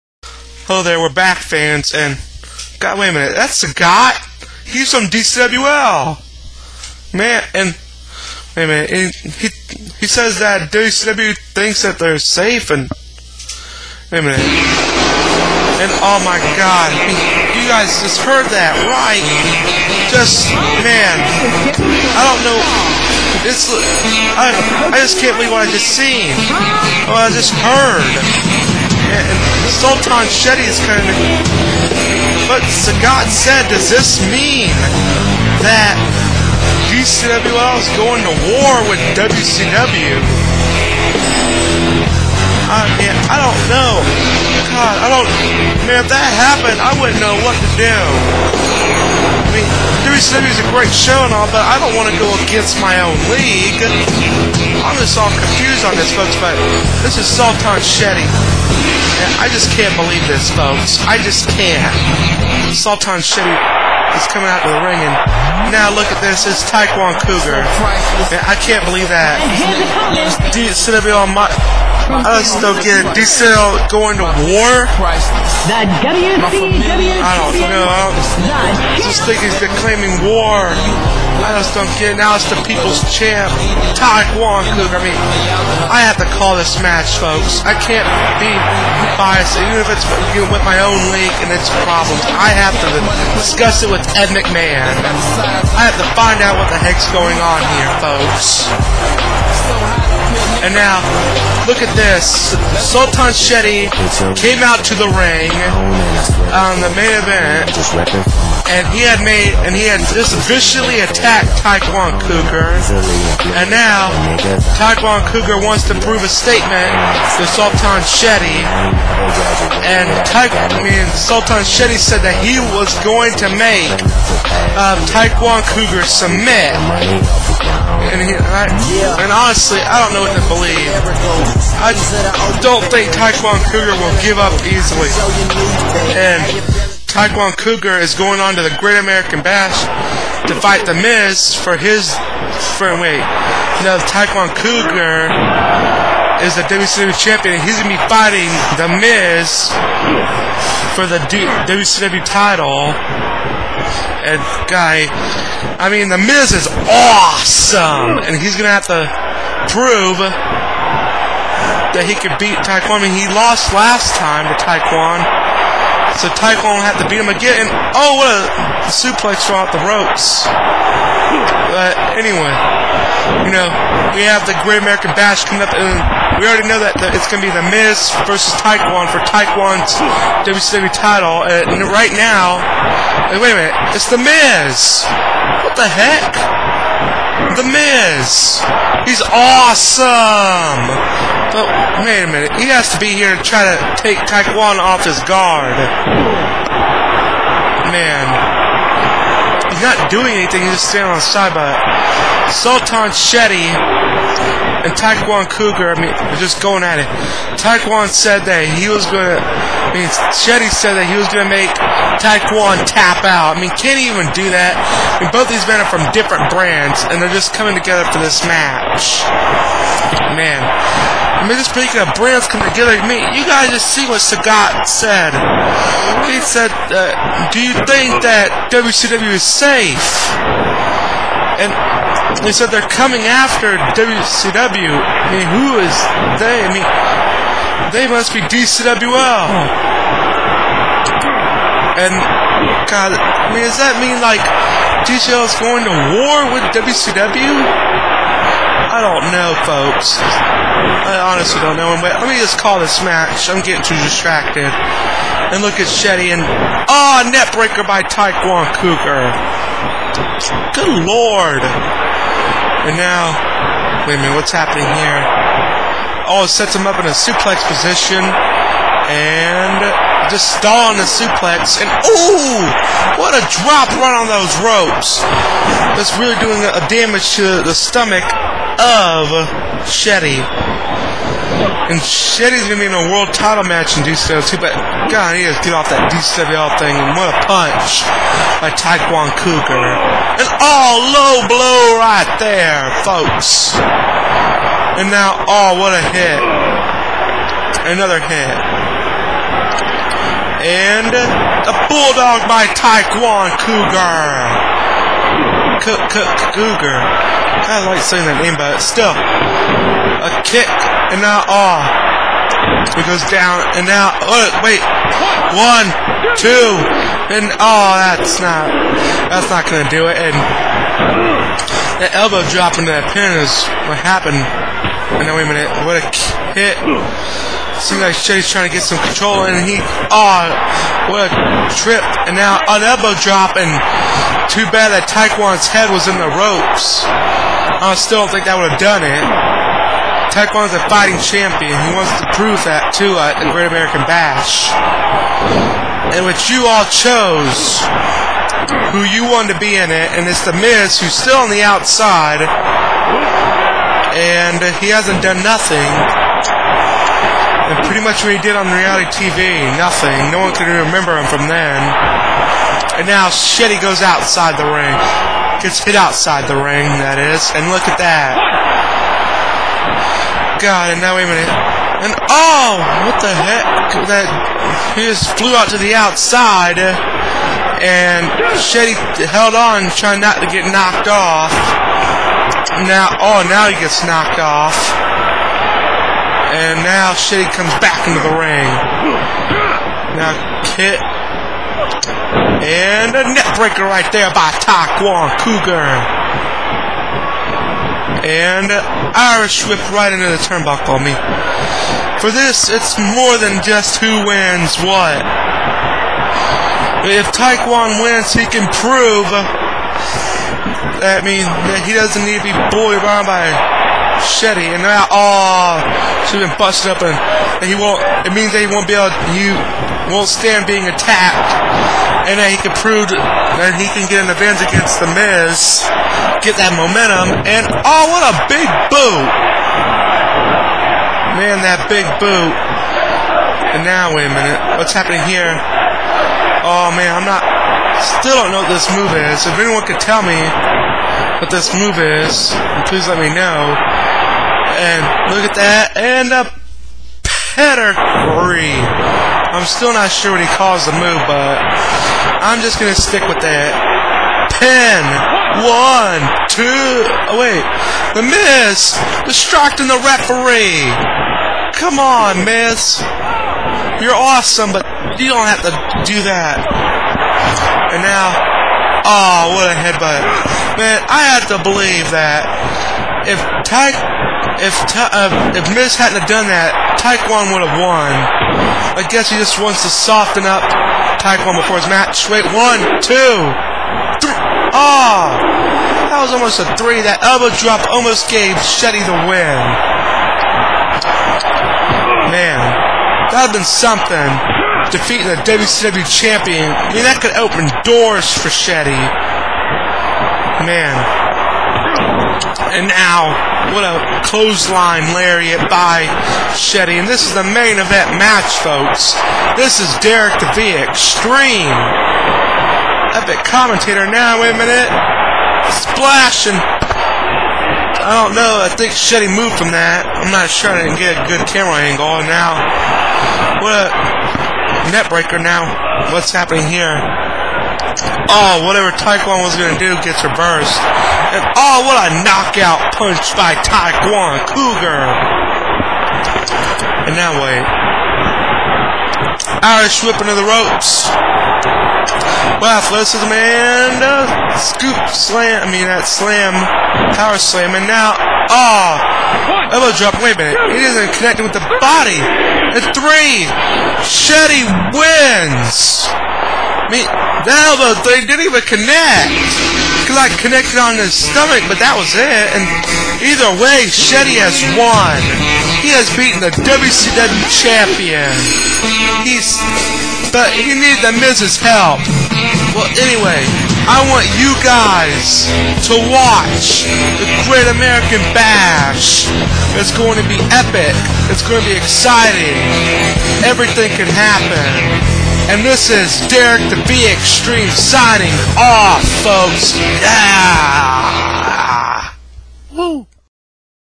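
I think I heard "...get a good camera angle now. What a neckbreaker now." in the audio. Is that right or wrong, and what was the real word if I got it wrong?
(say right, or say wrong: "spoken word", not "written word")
right.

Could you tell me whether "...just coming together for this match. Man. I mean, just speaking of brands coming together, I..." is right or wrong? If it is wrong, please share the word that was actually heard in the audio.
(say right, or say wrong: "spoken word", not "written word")
right.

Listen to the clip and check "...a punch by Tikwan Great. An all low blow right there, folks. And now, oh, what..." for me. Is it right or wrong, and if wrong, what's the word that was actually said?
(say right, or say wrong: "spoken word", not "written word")
wrong: "Coger", not "Great".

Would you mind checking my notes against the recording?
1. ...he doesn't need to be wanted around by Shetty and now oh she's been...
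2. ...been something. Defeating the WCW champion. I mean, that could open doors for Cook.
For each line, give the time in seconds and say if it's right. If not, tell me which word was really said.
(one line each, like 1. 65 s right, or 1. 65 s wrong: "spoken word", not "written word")
1. 411 s wrong: "bullied", not "wanted"
2. 493 s wrong: "Shetty", not "Cook".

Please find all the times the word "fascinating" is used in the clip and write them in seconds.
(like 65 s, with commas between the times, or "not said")
not said.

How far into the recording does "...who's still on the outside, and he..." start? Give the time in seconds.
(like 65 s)
350 s.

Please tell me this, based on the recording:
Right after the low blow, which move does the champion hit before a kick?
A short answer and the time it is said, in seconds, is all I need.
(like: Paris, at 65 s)
Bulldog, at 301 s.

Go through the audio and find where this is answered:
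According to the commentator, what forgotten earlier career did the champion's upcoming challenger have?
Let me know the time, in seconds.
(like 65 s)
358 s.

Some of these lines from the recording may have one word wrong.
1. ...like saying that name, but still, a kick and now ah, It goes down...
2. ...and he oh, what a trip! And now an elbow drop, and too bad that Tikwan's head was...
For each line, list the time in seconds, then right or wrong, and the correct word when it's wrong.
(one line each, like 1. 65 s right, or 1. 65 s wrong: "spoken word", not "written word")
1. 307 s right
2. 329 s right.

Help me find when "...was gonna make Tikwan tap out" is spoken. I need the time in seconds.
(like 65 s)
211 s.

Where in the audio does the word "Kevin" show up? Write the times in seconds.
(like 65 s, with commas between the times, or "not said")
not said.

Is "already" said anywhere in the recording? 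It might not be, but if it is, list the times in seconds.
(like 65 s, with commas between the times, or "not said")
176 s.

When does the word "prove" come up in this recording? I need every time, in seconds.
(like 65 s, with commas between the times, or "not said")
116 s, 159 s, 342 s, 408 s, 422 s.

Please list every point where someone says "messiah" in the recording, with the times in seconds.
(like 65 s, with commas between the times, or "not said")
not said.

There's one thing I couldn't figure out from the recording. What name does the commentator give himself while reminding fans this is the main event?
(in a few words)
Derek DeVee Extreme.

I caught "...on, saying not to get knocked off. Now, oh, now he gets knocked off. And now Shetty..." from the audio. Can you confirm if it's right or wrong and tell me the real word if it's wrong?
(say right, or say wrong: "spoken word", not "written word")
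wrong: "trying", not "saying".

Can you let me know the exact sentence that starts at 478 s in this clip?
I guess he just wants to soften up Tikwan before his match.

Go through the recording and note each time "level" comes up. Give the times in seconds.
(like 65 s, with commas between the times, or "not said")
not said.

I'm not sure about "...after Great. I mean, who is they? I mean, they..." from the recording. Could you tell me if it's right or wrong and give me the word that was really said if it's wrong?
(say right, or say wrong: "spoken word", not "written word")
wrong: "WCW", not "Great".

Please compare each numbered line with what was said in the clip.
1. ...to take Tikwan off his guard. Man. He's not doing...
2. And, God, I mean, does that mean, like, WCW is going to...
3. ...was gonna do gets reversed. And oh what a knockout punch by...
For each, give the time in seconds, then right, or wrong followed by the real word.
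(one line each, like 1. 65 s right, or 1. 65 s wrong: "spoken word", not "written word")
1. 193 s right
2. 241 s wrong: "DCL", not "WCW"
3. 529 s right.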